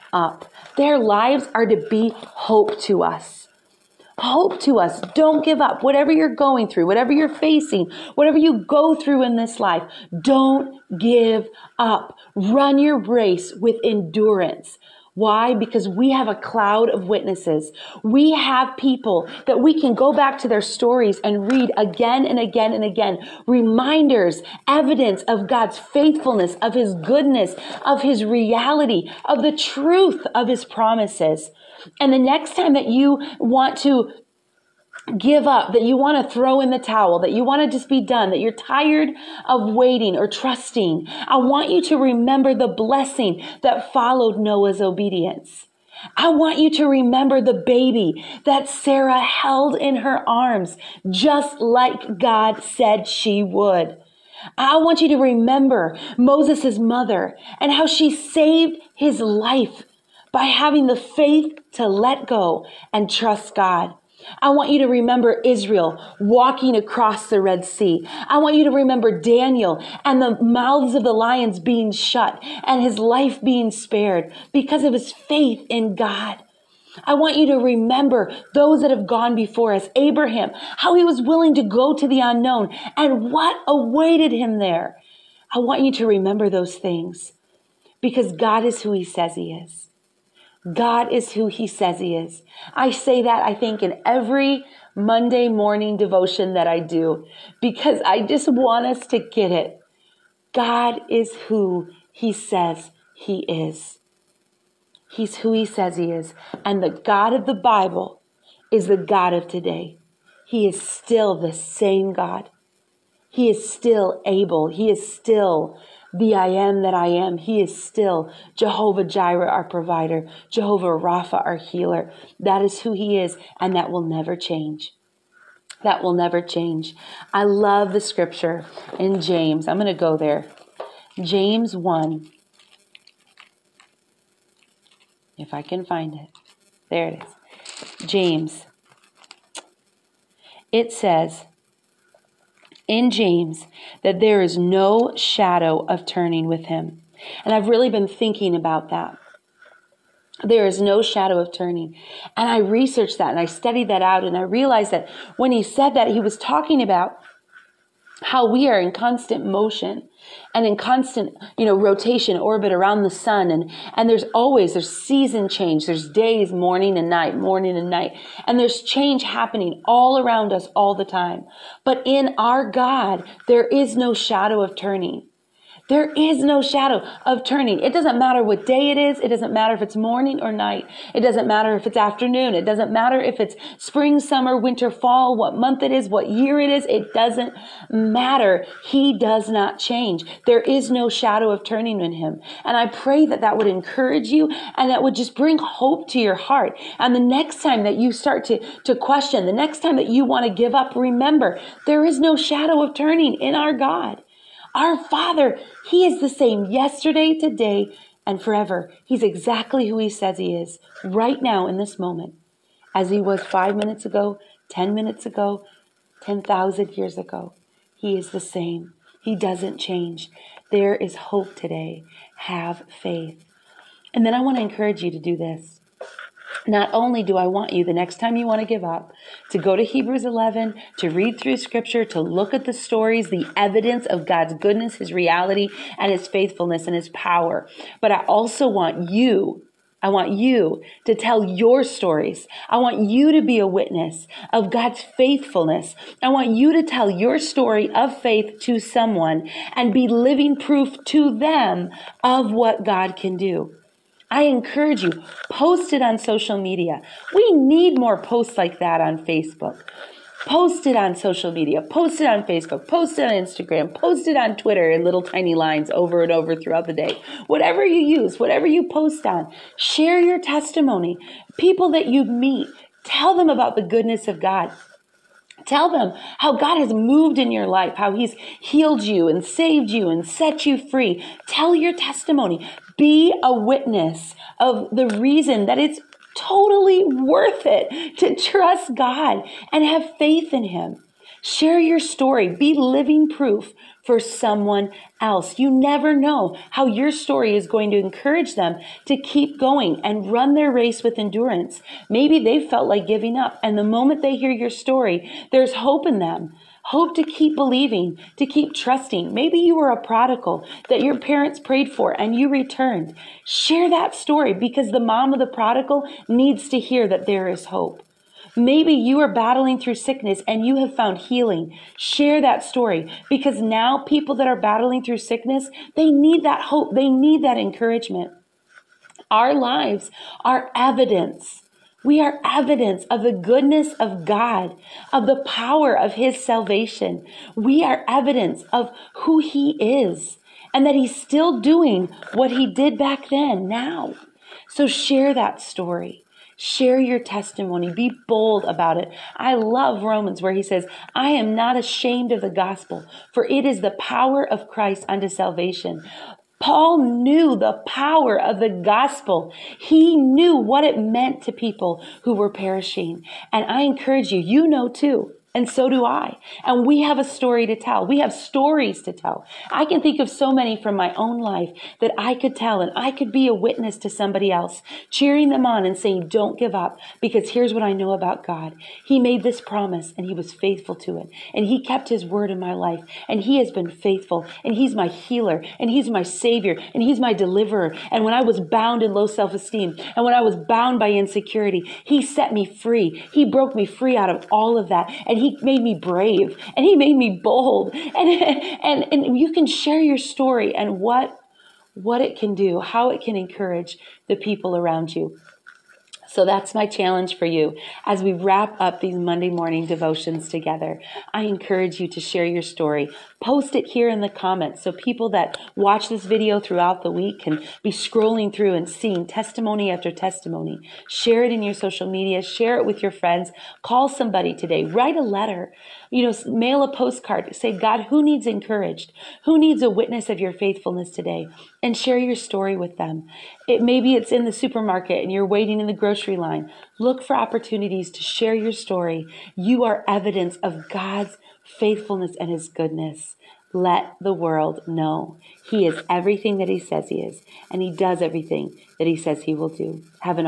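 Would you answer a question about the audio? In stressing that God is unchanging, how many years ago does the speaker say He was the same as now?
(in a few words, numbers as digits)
10,000.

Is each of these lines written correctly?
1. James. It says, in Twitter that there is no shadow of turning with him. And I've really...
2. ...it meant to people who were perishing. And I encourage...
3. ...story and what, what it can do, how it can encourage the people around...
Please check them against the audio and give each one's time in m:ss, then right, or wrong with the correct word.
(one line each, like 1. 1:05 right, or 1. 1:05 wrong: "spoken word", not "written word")
1. 2:18 wrong: "James", not "Twitter"
2. 6:00 right
3. 6:40 right.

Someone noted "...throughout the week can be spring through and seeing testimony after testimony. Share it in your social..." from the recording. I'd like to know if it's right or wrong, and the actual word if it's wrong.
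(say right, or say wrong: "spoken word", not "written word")
wrong: "scrolling", not "spring".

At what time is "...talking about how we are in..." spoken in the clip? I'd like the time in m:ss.
2:36.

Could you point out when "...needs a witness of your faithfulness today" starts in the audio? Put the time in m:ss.
7:09.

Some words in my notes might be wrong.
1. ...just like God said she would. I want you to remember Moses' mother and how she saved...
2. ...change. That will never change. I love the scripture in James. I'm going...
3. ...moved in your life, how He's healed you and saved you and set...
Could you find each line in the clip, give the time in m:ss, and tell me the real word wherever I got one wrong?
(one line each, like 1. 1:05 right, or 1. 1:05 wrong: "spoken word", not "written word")
1. 0:51 right
2. 2:04 right
3. 4:36 right.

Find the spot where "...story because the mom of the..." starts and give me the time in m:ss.
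5:14.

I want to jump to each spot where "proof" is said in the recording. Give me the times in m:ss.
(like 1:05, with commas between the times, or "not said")
4:10, 4:53.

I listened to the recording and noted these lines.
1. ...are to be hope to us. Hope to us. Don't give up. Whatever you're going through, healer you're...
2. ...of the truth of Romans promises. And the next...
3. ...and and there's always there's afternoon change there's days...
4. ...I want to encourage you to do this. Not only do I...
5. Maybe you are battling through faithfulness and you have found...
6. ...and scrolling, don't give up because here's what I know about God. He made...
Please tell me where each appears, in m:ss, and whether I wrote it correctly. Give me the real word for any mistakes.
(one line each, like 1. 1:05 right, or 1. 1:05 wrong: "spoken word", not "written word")
1. 0:01 wrong: "whatever", not "healer"
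2. 0:29 wrong: "His", not "Romans"
3. 2:43 wrong: "season", not "afternoon"
4. 3:44 right
5. 5:18 wrong: "sickness", not "faithfulness"
6. 6:15 wrong: "saying", not "scrolling".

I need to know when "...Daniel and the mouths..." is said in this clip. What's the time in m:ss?
1:09.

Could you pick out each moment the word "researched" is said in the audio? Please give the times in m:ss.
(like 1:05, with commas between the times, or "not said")
2:32.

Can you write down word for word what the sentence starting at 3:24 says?
Our Father, He is the same yesterday, today, and forever.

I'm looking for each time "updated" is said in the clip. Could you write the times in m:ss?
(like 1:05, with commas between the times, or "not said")
not said.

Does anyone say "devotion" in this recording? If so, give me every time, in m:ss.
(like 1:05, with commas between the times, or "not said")
1:35, 6:49.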